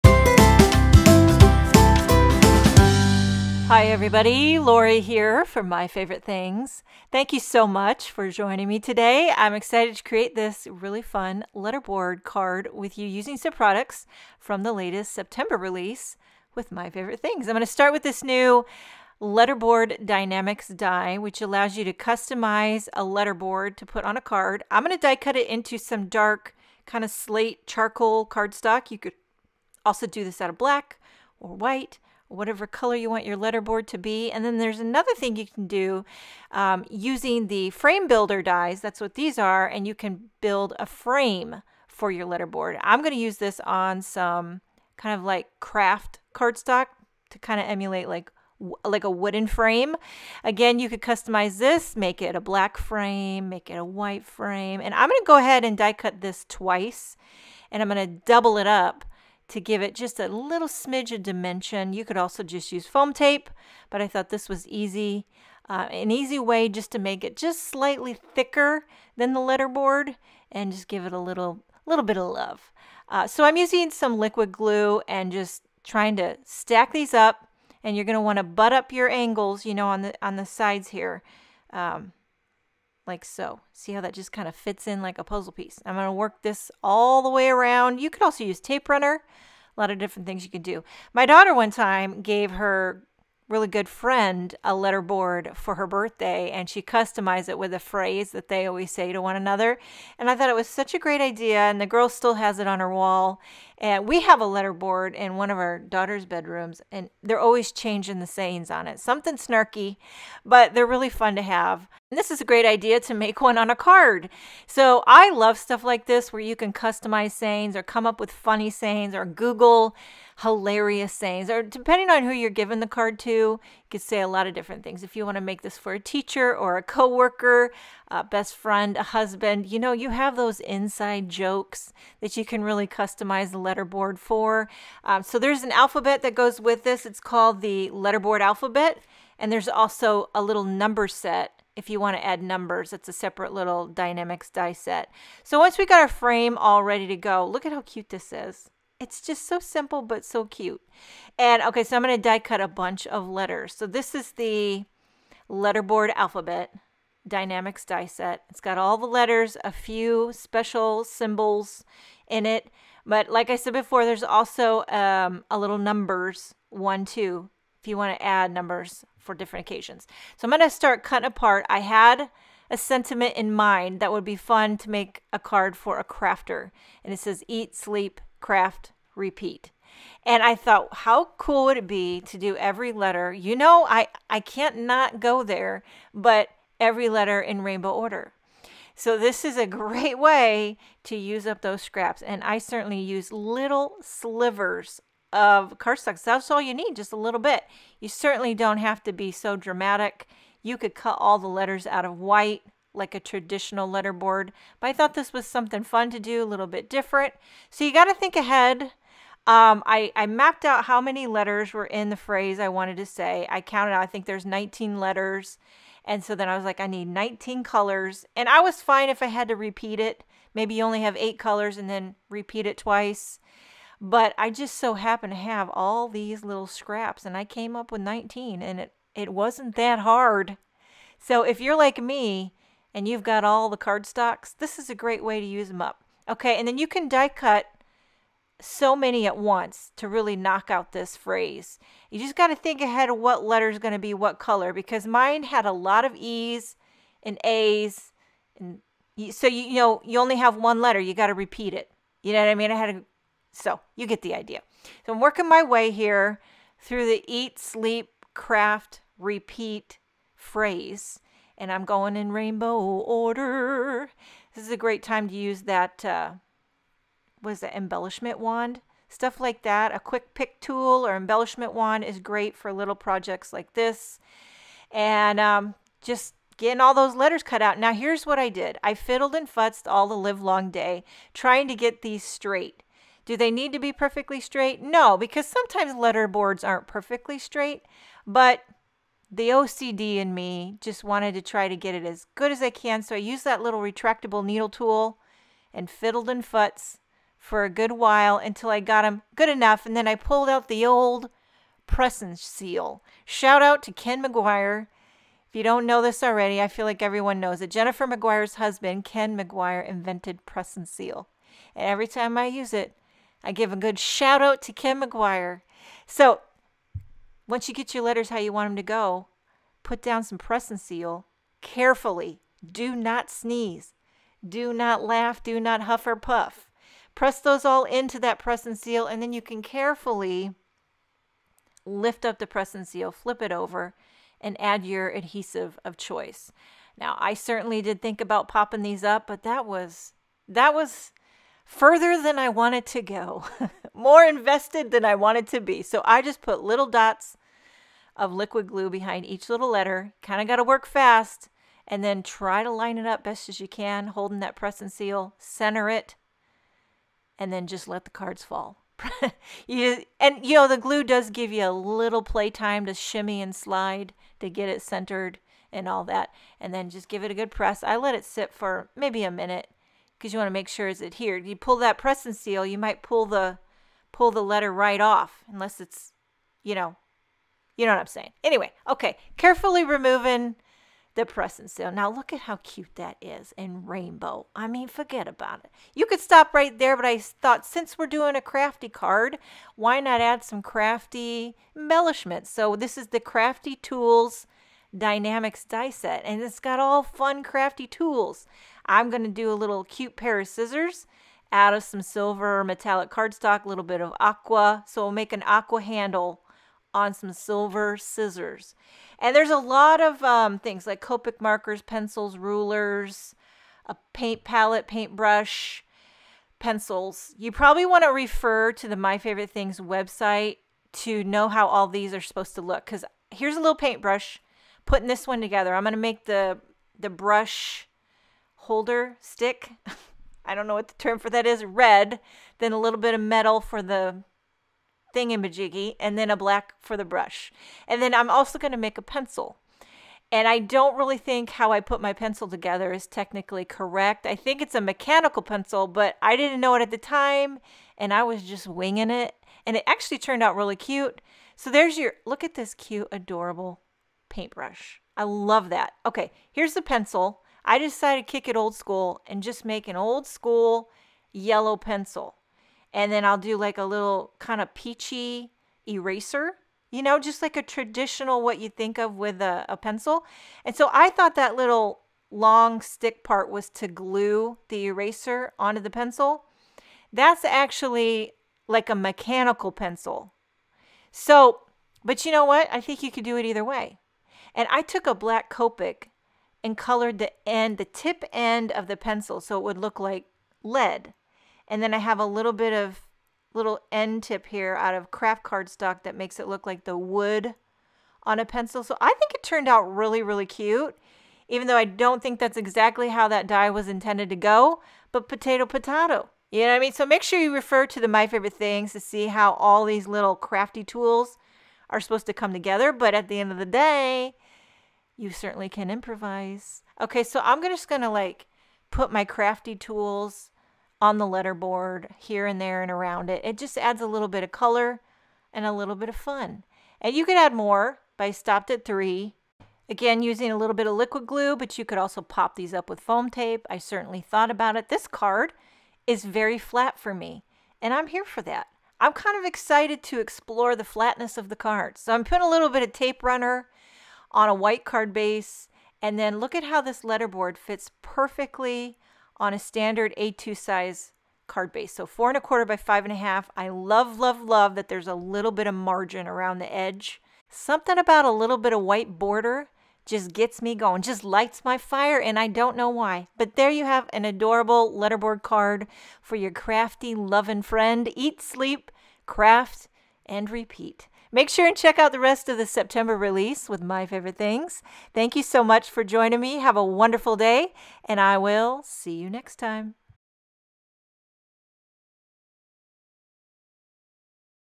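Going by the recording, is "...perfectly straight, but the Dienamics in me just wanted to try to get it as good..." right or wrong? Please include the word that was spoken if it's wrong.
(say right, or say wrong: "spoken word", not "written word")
wrong: "OCD", not "Dienamics".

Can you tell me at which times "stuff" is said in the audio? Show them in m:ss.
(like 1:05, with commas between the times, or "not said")
1:55, 4:29.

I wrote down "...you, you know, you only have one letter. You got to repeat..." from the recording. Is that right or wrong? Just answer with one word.
right.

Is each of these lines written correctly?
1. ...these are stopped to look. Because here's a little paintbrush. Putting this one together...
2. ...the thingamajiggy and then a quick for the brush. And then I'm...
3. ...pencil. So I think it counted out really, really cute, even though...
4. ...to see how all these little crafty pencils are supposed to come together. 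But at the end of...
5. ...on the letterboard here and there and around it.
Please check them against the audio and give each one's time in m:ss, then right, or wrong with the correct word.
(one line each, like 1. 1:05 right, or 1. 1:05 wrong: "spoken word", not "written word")
1. 7:01 wrong: "supposed", not "stopped"
2. 7:13 wrong: "black", not "quick"
3. 8:18 wrong: "turned", not "counted"
4. 8:28 wrong: "tools", not "pencils"
5. 8:41 right.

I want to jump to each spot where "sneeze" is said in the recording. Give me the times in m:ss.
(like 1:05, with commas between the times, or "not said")
5:23.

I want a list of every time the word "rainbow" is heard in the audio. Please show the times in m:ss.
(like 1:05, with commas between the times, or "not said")
3:07, 4:22, 6:23.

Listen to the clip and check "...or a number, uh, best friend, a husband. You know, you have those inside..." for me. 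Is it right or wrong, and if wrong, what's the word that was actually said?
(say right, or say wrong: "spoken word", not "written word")
wrong: "coworker", not "number".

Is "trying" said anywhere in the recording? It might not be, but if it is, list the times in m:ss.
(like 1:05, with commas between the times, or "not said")
1:15, 4:41.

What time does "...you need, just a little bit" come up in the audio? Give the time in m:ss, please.
3:16.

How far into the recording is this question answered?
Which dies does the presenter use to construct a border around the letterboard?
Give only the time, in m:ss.
0:37.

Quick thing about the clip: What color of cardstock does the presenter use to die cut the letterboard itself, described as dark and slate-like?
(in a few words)
Charcoal.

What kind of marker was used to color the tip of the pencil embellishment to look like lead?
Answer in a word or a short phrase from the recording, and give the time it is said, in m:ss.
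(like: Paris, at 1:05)
Black Copic, at 8:05.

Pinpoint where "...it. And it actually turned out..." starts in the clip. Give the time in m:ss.
7:29.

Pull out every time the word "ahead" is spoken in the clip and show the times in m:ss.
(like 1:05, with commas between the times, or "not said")
0:55, 3:28, 4:02.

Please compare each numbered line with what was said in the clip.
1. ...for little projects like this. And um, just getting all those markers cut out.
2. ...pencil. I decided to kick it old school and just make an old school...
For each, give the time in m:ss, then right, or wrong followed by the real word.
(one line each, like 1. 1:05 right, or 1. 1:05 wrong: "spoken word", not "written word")
1. 4:32 wrong: "letters", not "markers"
2. 7:36 right.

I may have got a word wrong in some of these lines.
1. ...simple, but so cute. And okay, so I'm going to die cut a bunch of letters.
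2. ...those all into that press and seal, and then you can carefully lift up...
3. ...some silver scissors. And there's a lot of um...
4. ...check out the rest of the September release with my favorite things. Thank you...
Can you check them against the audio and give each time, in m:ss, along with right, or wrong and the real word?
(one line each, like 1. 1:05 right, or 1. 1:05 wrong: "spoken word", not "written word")
1. 2:29 right
2. 5:27 right
3. 6:47 right
4. 9:31 right.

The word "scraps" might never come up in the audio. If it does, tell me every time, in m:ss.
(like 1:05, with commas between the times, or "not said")
3:11, 3:46.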